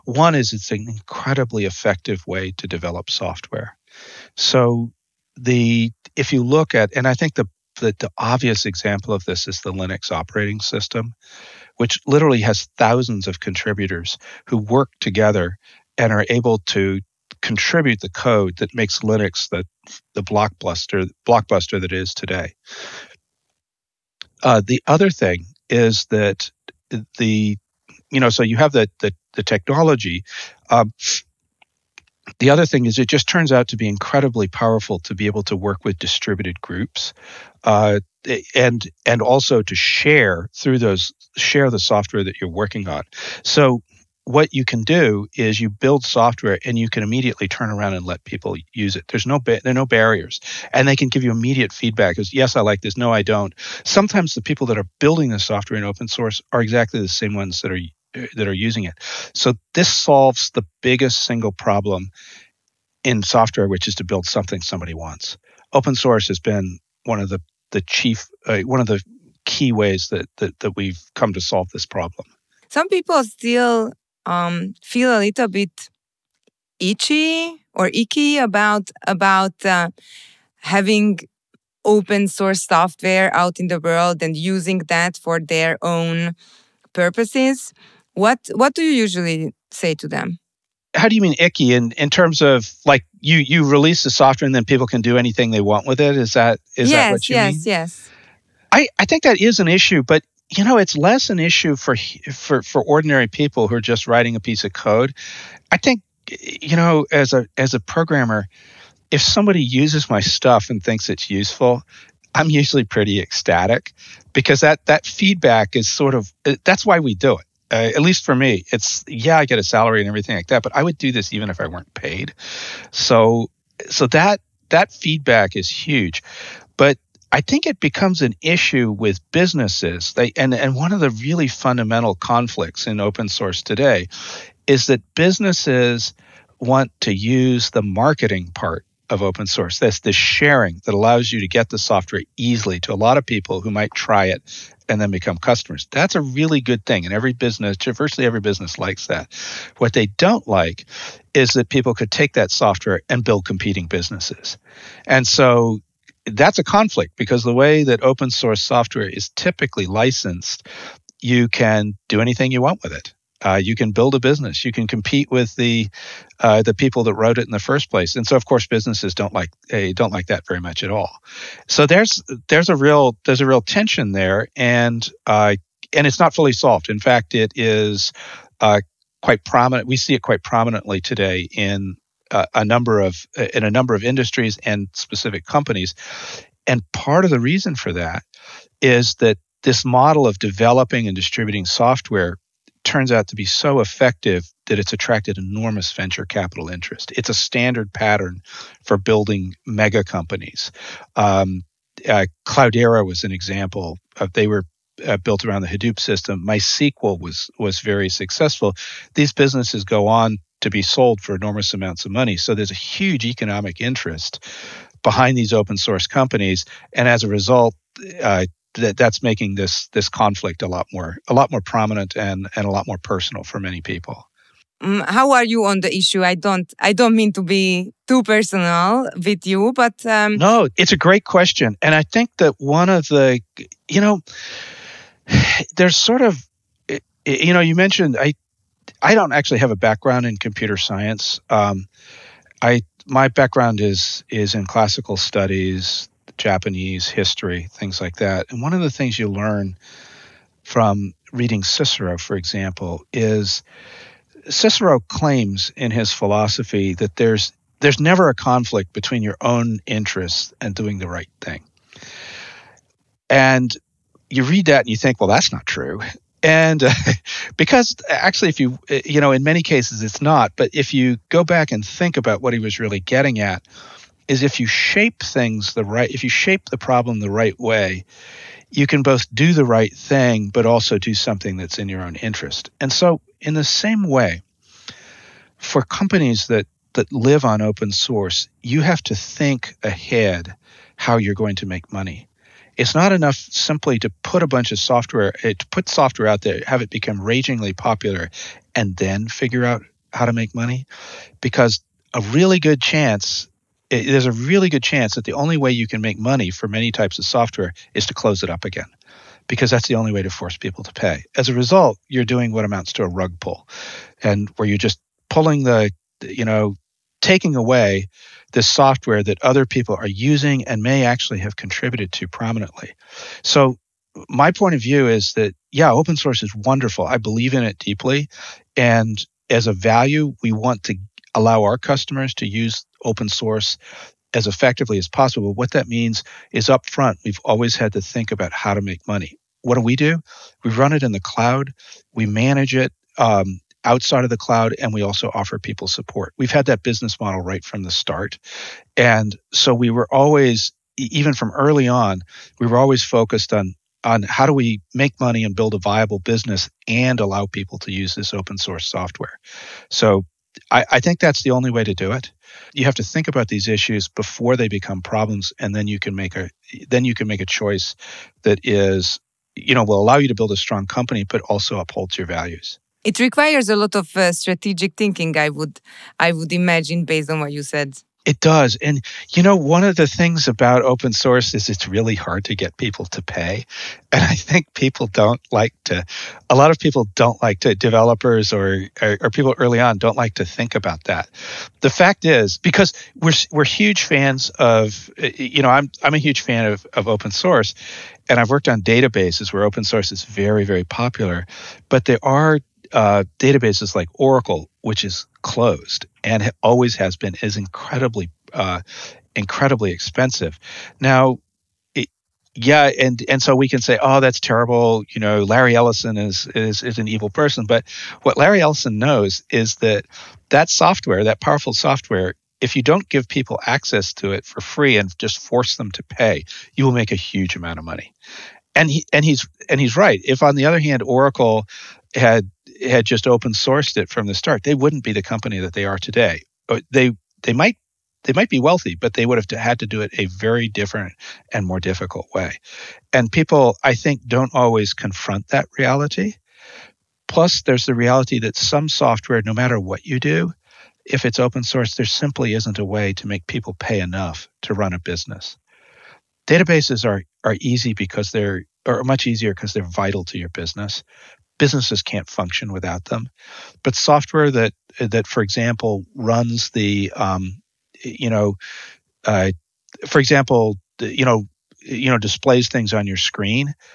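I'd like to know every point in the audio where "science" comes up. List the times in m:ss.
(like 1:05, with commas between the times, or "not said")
4:00.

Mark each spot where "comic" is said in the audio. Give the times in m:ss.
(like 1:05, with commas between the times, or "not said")
not said.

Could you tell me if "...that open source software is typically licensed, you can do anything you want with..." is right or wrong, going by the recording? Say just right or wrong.
right.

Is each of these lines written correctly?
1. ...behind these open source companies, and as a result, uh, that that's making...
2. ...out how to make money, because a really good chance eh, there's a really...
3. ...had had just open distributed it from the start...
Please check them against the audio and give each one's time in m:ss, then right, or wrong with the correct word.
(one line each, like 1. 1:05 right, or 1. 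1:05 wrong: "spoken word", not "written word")
1. 3:35 right
2. 4:59 right
3. 7:12 wrong: "sourced", not "distributed".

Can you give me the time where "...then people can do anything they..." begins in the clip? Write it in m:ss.
1:34.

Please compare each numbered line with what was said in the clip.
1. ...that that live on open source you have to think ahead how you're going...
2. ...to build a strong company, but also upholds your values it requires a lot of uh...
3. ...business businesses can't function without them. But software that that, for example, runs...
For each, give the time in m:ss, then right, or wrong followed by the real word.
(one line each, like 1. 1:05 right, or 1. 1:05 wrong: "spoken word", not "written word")
1. 4:46 right
2. 6:10 right
3. 7:40 right.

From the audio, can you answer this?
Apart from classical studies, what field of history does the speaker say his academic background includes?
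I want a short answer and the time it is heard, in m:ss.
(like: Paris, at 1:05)
Japanese history, at 4:06.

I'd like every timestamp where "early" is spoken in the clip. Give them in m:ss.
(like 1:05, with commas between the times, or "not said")
5:51, 6:29.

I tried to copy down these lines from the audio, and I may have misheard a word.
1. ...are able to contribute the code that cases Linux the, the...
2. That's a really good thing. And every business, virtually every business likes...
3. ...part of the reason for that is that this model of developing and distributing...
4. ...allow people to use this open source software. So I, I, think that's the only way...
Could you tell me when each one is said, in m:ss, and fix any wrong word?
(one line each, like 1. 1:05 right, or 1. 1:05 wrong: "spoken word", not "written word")
1. 0:16 wrong: "makes", not "cases"
2. 2:25 right
3. 3:06 right
4. 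5:57 right.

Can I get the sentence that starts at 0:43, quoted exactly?
So what you can do is you build software and you can immediately turn around and let people use it.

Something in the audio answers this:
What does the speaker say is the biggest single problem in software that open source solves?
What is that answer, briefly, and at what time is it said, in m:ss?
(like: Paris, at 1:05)
something somebody wants, at 1:04.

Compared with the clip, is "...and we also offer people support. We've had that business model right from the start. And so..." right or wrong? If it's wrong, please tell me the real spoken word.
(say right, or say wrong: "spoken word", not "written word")
right.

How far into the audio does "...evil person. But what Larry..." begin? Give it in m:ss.
6:57.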